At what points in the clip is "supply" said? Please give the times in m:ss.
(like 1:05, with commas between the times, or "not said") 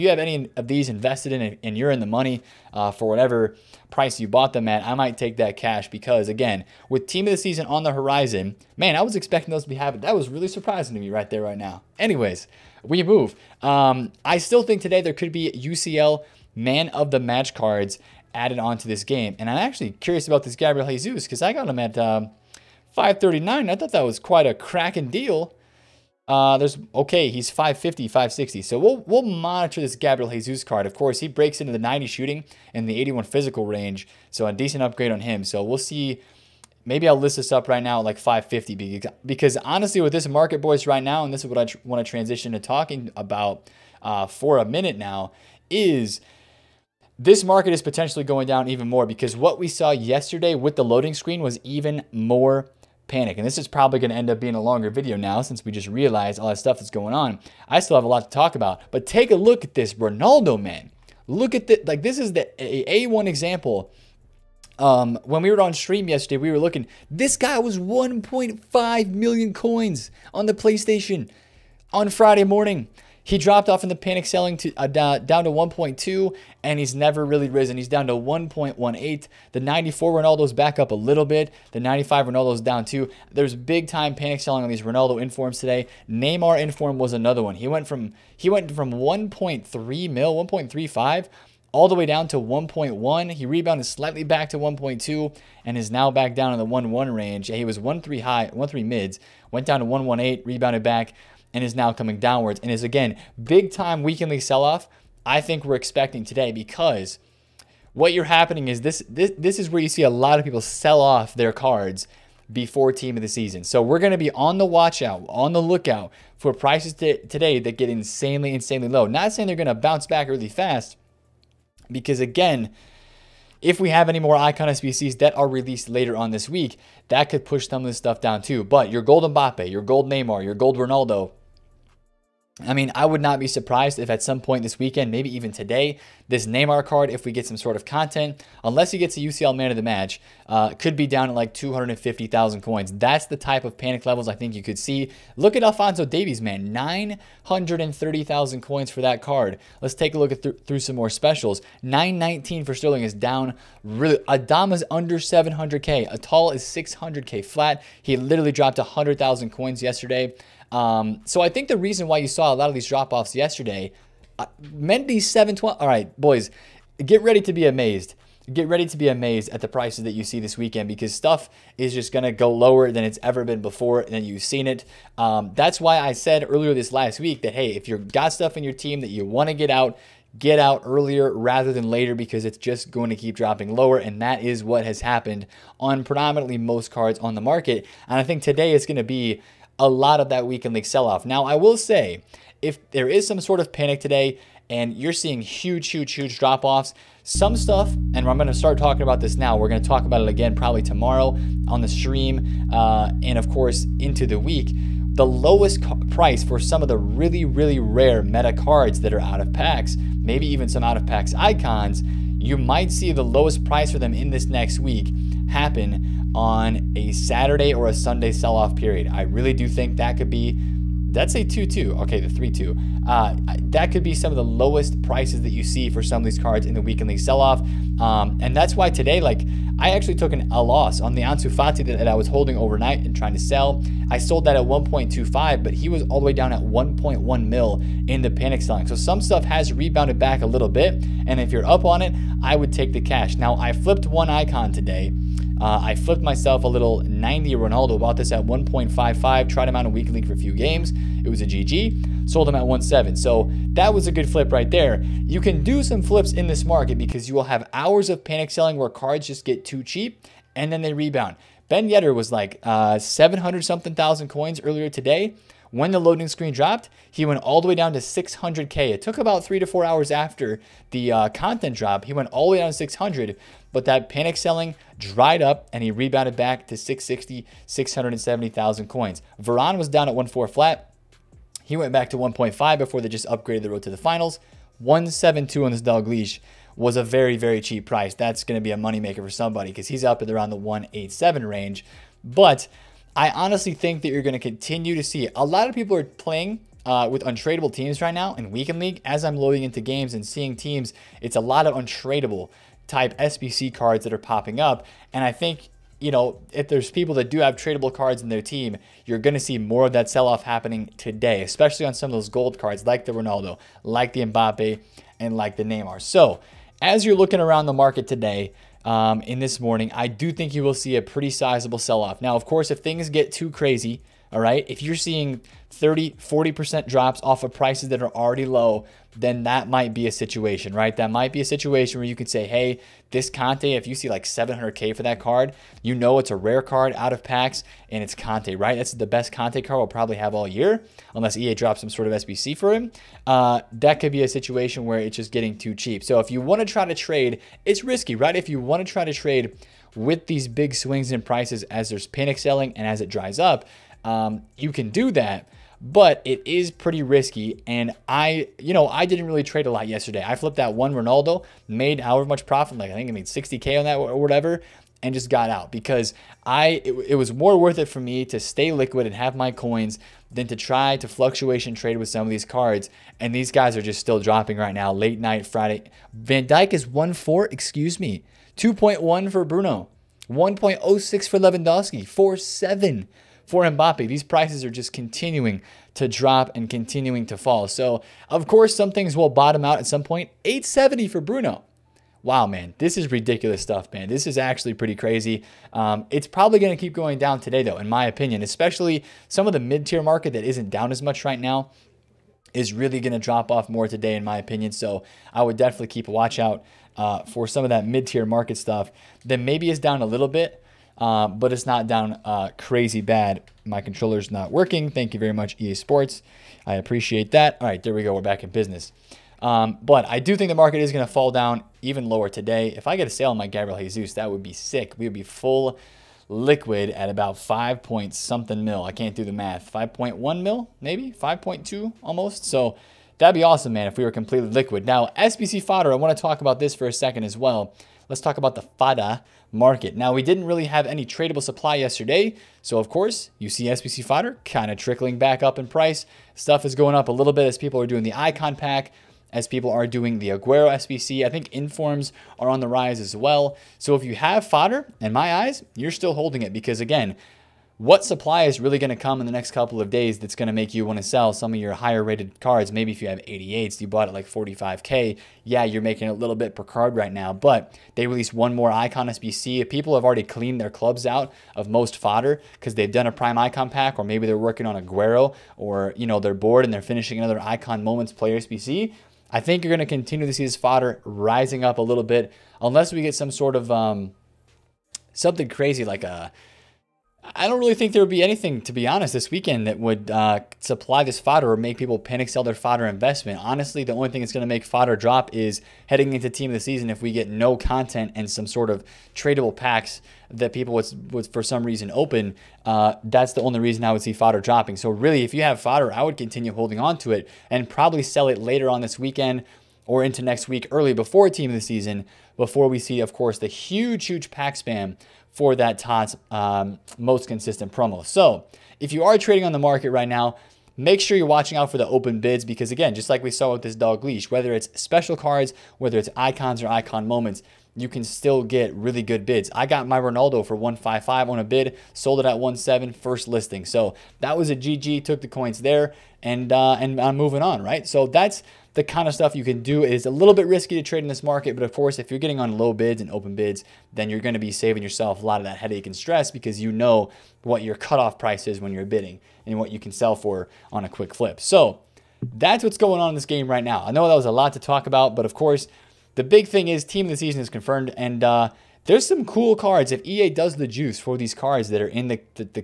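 7:21, 7:38, 8:10.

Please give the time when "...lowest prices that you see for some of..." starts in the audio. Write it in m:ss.
3:44.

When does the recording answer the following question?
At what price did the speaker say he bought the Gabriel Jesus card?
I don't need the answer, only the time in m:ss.
0:22.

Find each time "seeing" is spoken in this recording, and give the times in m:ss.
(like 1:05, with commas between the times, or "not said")
3:15, 5:00, 5:24.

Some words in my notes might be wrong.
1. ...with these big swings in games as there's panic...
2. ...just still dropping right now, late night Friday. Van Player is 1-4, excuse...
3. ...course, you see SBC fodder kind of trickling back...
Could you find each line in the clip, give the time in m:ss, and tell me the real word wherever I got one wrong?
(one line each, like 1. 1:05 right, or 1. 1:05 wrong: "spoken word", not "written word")
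1. 5:49 wrong: "prices", not "games"
2. 6:13 wrong: "Dijk", not "Player"
3. 7:22 right.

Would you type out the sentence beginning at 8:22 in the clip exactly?
Uh, that's the only reason I would see fodder dropping.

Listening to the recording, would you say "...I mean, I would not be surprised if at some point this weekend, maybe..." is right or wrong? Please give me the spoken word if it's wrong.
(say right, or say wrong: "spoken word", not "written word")
right.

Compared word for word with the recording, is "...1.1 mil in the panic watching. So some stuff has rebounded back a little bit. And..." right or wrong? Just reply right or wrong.
wrong.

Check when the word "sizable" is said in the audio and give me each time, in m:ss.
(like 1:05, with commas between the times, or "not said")
5:21.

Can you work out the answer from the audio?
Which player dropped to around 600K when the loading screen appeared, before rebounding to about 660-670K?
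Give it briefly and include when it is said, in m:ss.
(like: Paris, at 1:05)
Ben Yedder, at 4:21.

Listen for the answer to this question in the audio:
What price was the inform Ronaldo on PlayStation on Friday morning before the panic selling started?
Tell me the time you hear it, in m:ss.
1:07.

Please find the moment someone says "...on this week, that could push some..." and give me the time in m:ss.
2:06.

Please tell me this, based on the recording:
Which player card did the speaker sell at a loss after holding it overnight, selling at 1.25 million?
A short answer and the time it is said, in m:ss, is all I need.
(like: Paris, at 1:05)
Ansu Fati, at 3:51.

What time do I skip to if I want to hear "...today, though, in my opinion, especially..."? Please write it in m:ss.
6:37.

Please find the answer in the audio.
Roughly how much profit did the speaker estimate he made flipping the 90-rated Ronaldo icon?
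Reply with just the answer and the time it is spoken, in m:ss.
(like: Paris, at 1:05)
60K, at 6:03.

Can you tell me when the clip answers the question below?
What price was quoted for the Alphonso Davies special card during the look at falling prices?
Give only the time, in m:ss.
2:26.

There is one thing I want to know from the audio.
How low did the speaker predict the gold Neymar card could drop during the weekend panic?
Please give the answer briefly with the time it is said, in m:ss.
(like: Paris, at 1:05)
250,000 coins, at 2:21.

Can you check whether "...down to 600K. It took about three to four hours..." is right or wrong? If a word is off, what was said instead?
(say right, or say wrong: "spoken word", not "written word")
right.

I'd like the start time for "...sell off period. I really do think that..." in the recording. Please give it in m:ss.
3:38.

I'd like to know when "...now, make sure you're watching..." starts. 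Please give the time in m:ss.
8:40.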